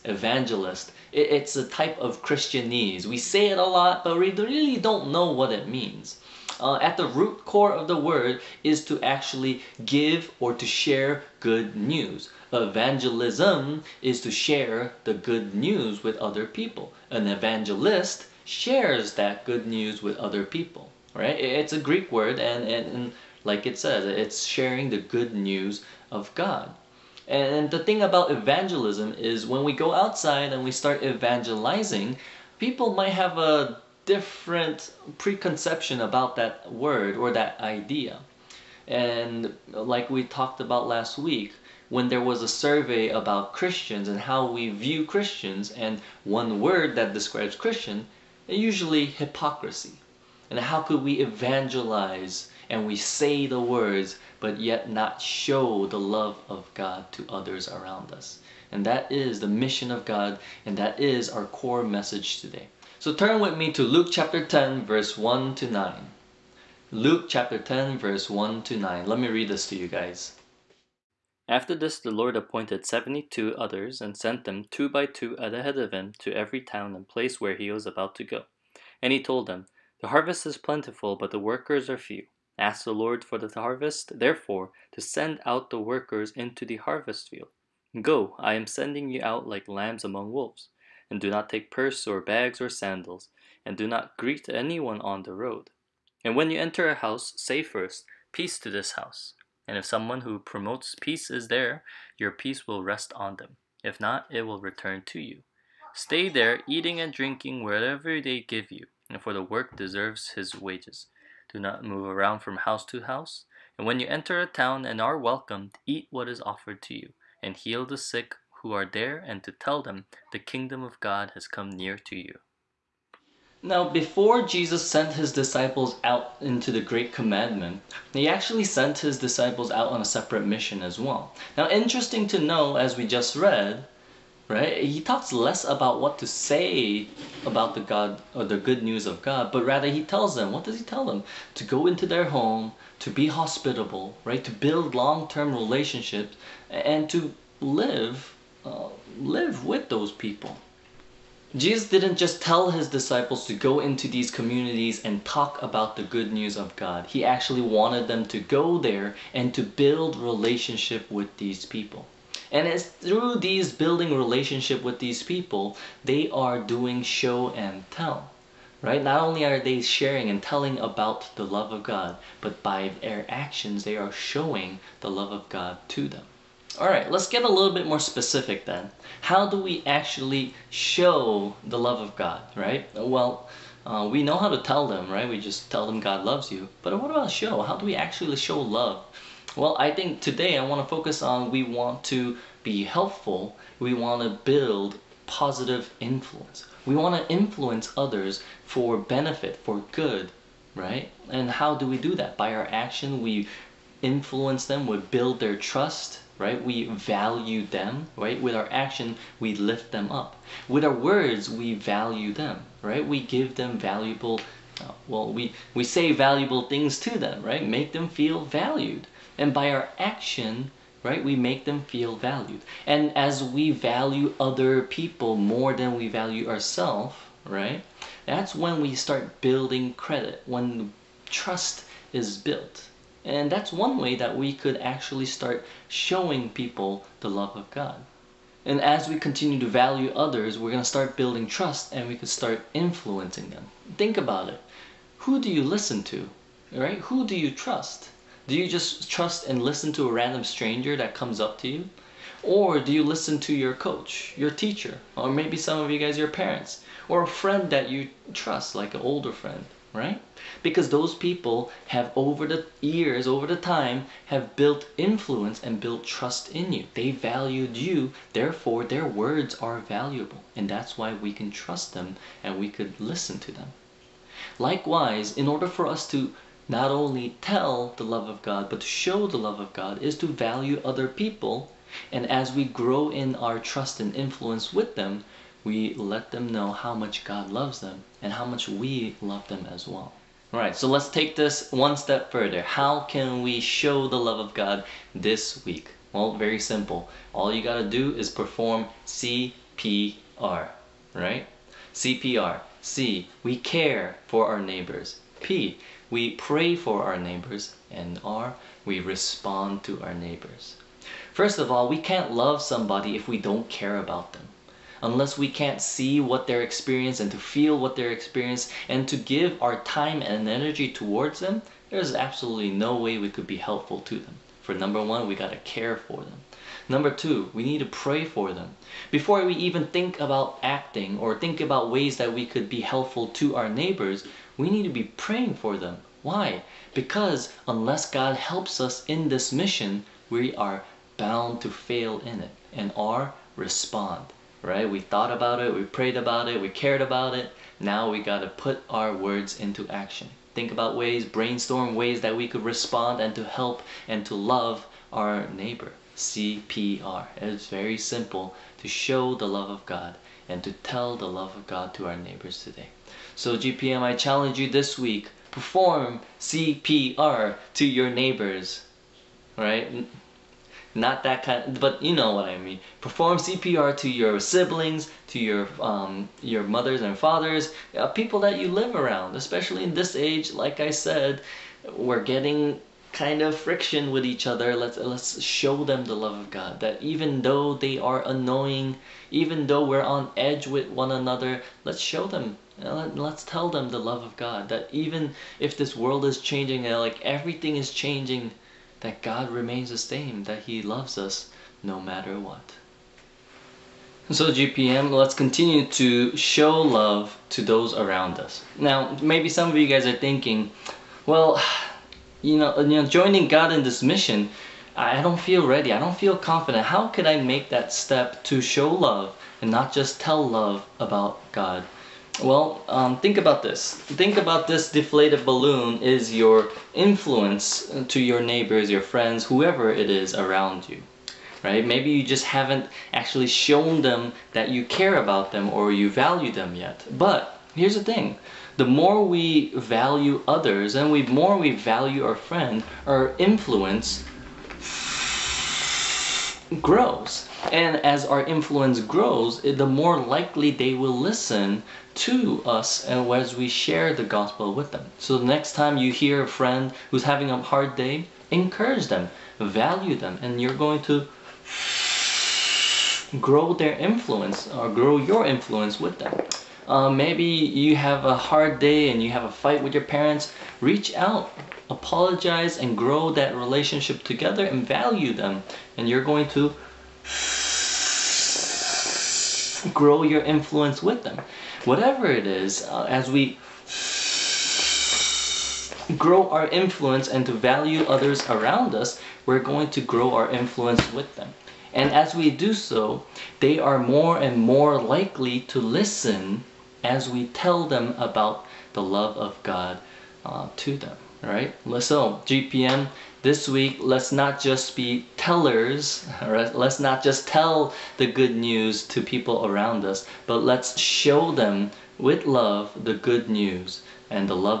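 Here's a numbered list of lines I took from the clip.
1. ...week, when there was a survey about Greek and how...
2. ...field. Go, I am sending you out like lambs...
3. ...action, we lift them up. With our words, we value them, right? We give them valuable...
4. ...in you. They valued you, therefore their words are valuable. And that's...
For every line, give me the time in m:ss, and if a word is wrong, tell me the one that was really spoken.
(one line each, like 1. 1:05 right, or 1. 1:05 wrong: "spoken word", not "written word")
1. 0:41 wrong: "Christians", not "Greek"
2. 1:27 right
3. 3:28 right
4. 4:26 right.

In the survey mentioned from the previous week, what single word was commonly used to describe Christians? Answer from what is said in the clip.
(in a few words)
hypocrisy.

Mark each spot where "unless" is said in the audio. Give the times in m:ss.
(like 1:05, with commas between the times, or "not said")
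5:15, 5:37.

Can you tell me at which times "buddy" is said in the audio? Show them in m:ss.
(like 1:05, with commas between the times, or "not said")
not said.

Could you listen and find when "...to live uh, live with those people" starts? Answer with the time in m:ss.
2:27.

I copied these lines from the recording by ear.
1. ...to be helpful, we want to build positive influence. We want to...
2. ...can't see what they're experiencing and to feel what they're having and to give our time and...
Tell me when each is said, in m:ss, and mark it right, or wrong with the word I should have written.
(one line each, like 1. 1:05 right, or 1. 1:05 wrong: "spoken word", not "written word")
1. 3:12 right
2. 5:15 wrong: "experiencing", not "having".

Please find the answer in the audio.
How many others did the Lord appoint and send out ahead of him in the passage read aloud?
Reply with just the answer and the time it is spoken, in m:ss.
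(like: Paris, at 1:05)
72, at 1:12.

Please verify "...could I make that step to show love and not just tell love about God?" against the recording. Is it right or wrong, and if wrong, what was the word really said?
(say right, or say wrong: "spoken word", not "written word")
right.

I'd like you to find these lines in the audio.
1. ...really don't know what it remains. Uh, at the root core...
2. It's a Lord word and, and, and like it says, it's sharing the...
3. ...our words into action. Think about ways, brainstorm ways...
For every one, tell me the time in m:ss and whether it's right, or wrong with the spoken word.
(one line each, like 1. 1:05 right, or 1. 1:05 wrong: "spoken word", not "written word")
1. 0:04 wrong: "means", not "remains"
2. 0:21 wrong: "Greek", not "Lord"
3. 5:48 right.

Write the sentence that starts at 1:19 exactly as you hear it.
And he told them, The harvest is plentiful, but the workers are few.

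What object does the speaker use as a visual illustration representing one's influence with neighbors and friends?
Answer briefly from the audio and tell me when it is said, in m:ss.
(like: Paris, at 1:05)
deflated balloon, at 7:04.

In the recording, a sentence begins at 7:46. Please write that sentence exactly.
Uh, maybe you have a hard day and you have a fight with your parents.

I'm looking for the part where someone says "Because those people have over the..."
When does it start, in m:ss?
4:20.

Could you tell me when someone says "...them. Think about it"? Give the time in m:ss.
4:03.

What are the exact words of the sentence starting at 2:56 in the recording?
All right, let's get a little bit more specific then.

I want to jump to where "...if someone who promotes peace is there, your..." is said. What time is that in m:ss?
1:39.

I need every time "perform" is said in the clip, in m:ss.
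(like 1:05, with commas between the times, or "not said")
4:58, 6:05, 6:13.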